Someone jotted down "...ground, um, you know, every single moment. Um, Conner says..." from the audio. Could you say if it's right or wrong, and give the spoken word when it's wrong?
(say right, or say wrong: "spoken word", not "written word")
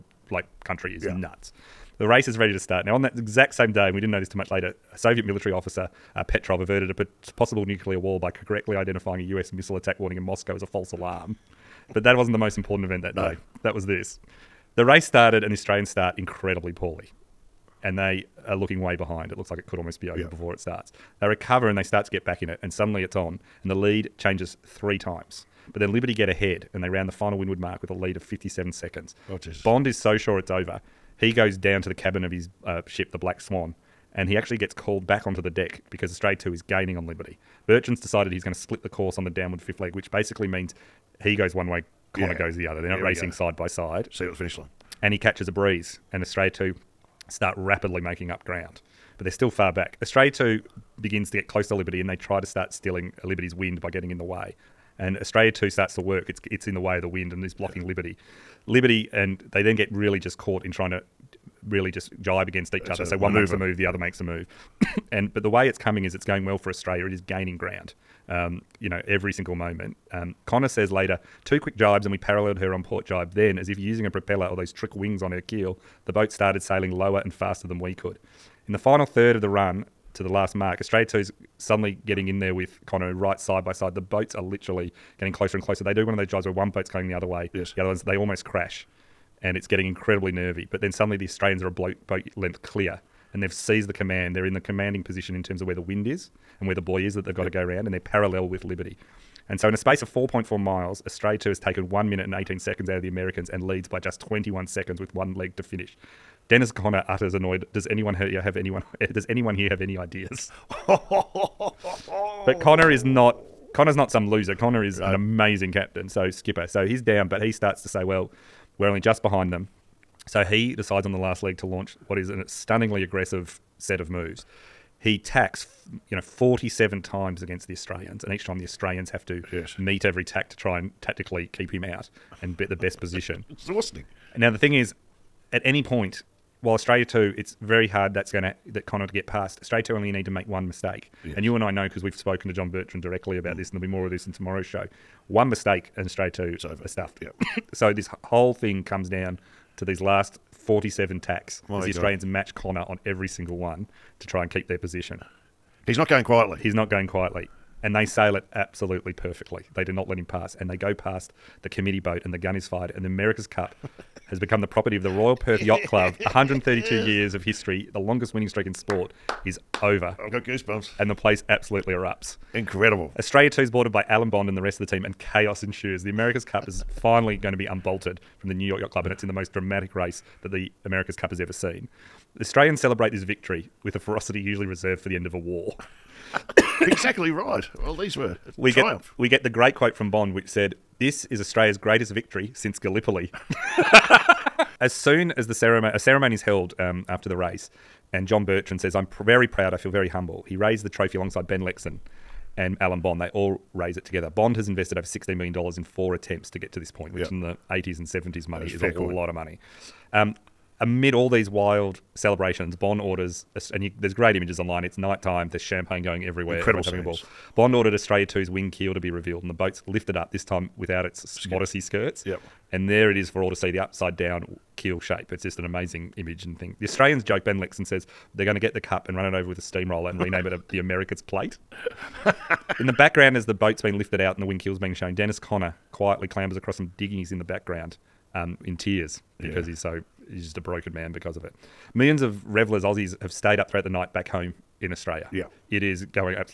right.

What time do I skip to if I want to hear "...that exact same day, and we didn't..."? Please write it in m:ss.
0:03.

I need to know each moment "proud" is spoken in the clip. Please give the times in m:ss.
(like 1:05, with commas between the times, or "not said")
3:19.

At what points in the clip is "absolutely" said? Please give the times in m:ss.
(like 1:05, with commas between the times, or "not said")
2:38, 2:51.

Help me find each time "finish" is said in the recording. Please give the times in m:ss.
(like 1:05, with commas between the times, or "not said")
0:44, 1:45.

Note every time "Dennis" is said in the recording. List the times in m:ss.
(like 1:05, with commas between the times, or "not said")
1:46, 3:55.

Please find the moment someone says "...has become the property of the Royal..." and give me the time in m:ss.
2:44.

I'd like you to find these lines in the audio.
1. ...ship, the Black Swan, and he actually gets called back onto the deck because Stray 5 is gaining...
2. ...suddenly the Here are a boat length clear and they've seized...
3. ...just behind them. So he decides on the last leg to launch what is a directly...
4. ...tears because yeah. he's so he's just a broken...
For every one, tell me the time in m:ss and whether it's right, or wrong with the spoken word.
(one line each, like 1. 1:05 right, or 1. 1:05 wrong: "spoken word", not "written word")
1. 0:32 wrong: "2", not "5"
2. 1:30 wrong: "Australians", not "Here"
3. 1:58 wrong: "stunningly", not "directly"
4. 3:58 right.